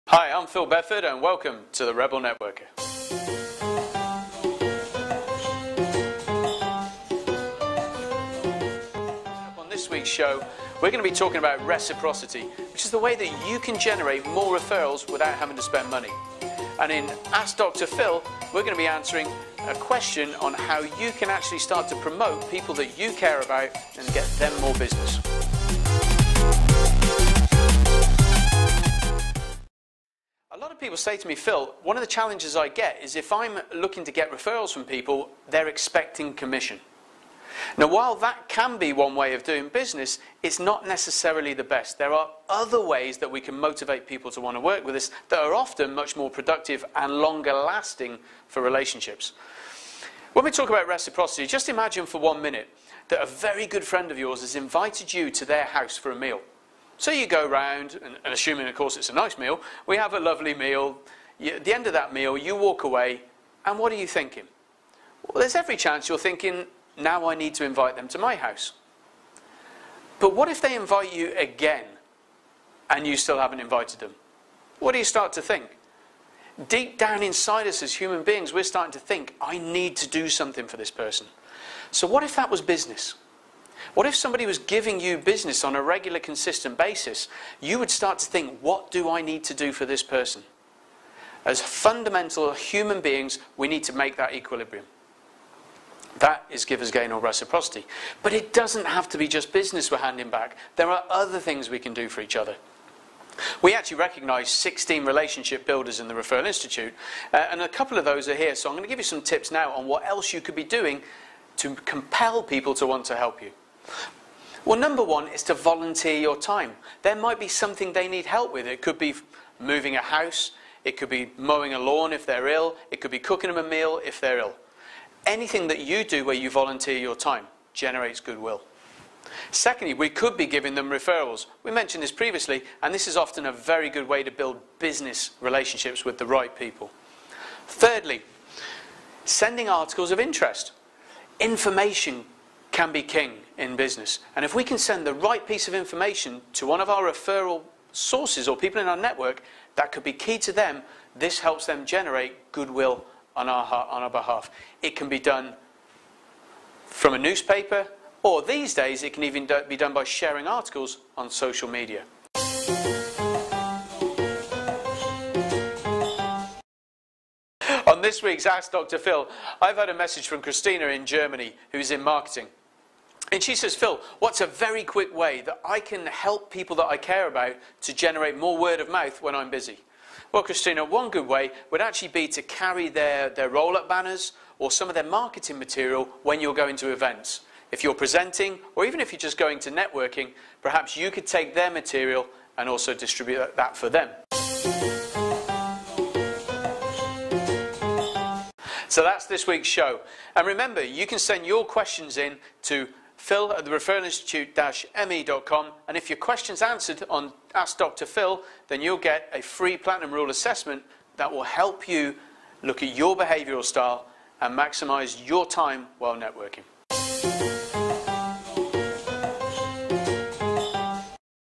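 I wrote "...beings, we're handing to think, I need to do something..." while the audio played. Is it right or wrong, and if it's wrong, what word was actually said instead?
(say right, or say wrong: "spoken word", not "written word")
wrong: "starting", not "handing".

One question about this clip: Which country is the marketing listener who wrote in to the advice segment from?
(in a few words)
Germany.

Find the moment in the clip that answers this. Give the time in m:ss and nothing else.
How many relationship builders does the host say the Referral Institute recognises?
1:44.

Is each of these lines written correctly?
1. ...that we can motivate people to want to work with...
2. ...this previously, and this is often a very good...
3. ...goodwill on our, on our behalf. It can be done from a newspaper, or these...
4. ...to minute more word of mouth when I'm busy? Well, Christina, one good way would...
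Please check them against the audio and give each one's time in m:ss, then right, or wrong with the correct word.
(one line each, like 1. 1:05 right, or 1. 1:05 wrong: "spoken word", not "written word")
1. 0:43 right
2. 2:12 right
3. 2:32 right
4. 2:57 wrong: "generate", not "minute".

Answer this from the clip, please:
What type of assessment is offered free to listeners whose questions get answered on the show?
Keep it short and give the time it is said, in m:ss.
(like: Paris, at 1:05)
Platinum Rule assessment, at 3:29.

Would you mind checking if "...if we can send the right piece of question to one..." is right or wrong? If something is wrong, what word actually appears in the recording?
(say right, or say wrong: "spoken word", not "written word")
wrong: "information", not "question".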